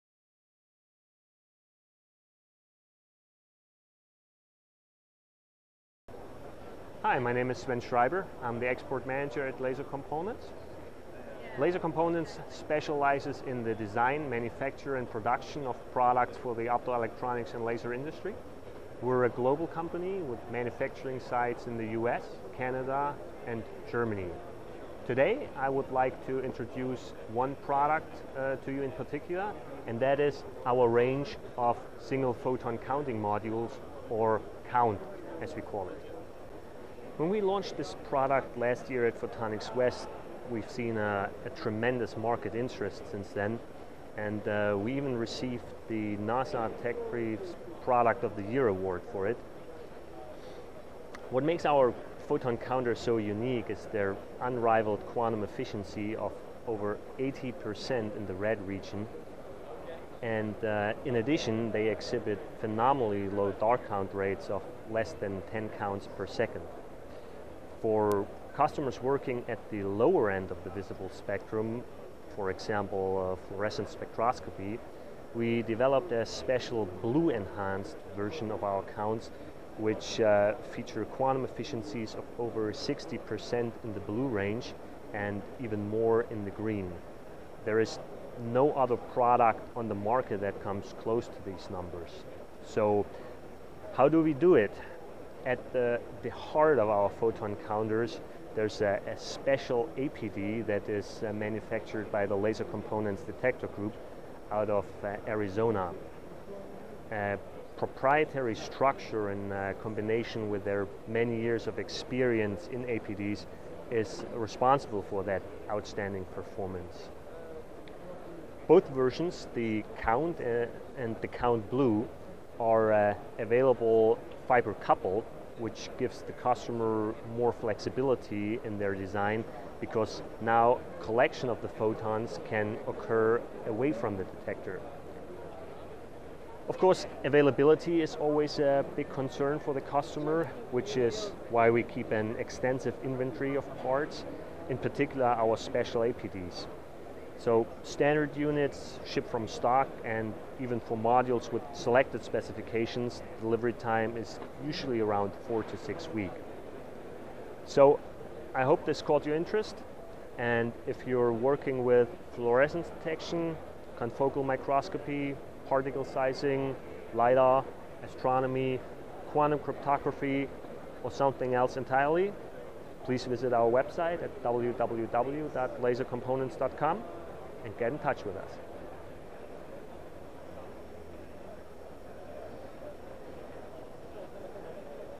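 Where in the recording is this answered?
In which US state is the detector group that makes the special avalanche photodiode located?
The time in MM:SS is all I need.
01:45.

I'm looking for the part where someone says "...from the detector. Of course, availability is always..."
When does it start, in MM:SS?
02:13.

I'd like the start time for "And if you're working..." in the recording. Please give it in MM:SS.
02:40.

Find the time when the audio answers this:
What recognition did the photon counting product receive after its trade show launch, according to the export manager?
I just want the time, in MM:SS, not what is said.
00:46.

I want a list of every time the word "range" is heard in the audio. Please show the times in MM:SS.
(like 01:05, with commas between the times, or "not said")
00:30, 01:24.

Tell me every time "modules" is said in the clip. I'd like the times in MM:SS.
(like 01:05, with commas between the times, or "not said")
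00:33, 02:30.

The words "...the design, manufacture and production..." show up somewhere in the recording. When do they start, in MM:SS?
00:13.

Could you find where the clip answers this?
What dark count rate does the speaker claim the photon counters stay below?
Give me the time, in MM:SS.
01:05.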